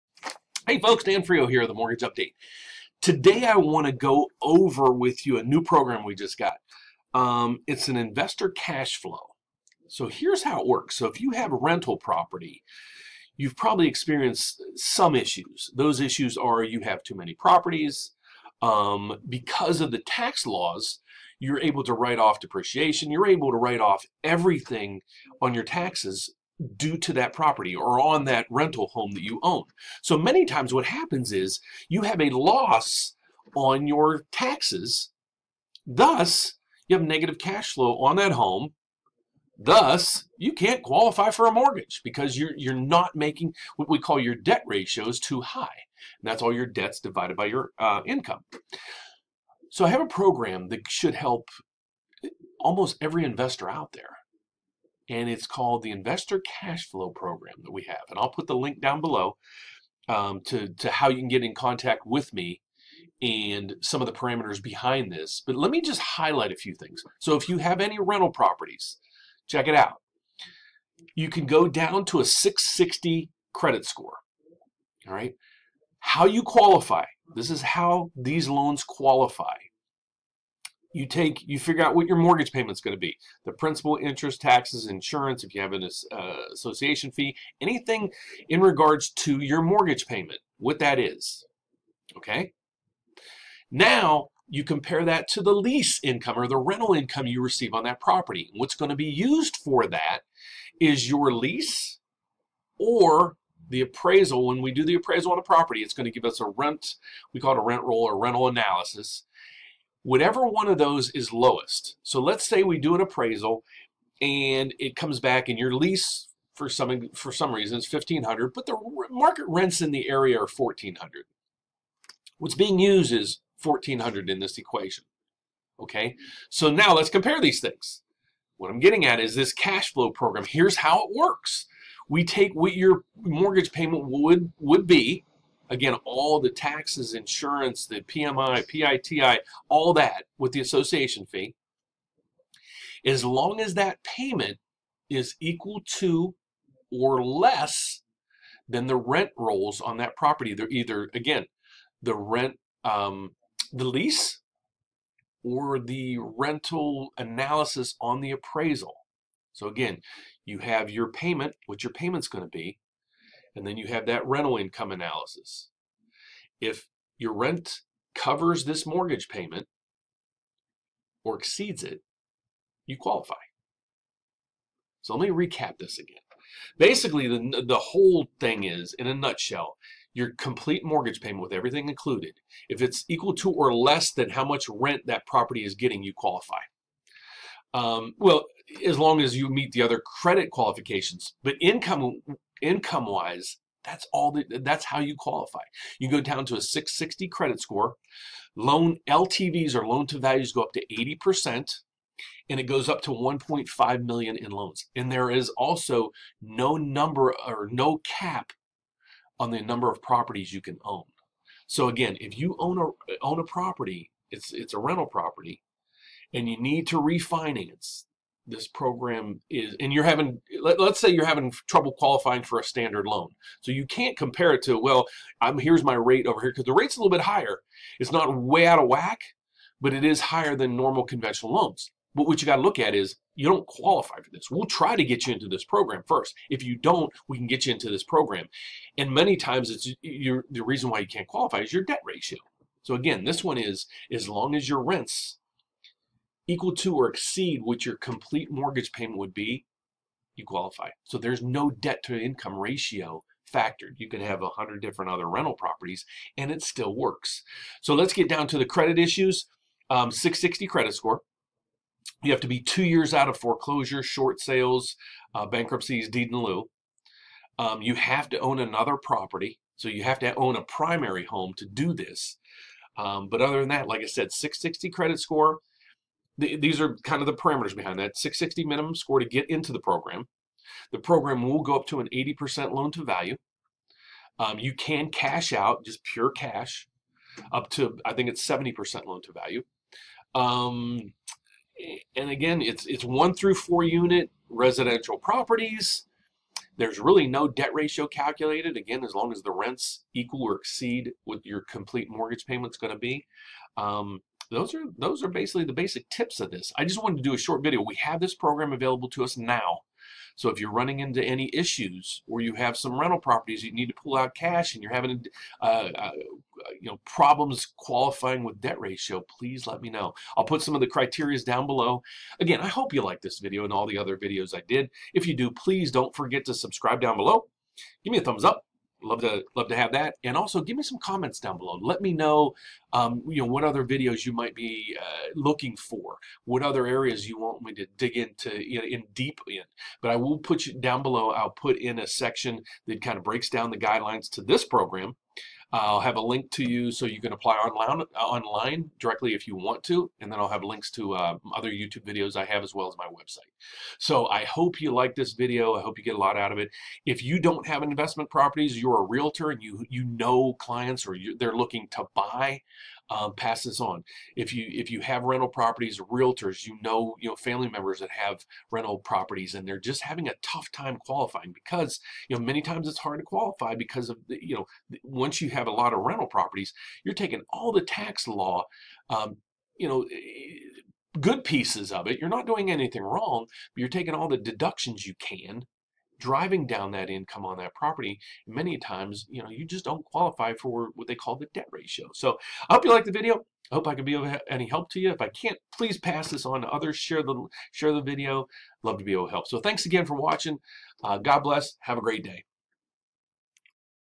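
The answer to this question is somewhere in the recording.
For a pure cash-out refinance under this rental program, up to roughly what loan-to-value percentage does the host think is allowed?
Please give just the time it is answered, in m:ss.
4:48.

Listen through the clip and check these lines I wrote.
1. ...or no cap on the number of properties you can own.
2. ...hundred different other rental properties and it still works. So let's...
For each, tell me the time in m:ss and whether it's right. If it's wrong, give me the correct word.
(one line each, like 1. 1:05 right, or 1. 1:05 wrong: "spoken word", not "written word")
1. 3:27 right
2. 4:14 right.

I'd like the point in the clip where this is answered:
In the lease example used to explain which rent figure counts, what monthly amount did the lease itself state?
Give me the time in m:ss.
1:57.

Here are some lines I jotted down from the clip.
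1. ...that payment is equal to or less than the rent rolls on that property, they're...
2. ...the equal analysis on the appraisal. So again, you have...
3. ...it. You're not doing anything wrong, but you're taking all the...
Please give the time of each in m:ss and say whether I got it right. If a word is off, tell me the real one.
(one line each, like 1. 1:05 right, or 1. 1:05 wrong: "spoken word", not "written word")
1. 2:23 right
2. 2:35 wrong: "rental", not "equal"
3. 6:22 right.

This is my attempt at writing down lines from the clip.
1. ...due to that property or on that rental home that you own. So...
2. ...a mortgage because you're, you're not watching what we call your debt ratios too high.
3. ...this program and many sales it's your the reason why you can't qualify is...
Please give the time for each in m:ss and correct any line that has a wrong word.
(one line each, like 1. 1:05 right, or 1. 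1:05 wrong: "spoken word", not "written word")
1. 0:26 right
2. 0:41 wrong: "making", not "watching"
3. 3:57 wrong: "times", not "sales".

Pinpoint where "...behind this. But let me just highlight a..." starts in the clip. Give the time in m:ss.
1:04.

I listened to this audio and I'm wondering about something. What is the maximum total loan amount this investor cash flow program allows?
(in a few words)
1.5 million.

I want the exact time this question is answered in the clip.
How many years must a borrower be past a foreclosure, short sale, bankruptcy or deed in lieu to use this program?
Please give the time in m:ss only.
4:22.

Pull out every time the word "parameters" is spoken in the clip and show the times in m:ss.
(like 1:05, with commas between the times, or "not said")
1:04, 4:37.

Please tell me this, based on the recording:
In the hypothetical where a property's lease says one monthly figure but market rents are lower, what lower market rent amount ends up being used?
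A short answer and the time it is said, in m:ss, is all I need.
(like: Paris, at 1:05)
1400, at 2:03.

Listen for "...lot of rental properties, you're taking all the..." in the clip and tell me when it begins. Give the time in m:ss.
6:15.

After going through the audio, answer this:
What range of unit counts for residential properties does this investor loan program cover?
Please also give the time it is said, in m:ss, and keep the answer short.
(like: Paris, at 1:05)
1 to 4 units, at 4:53.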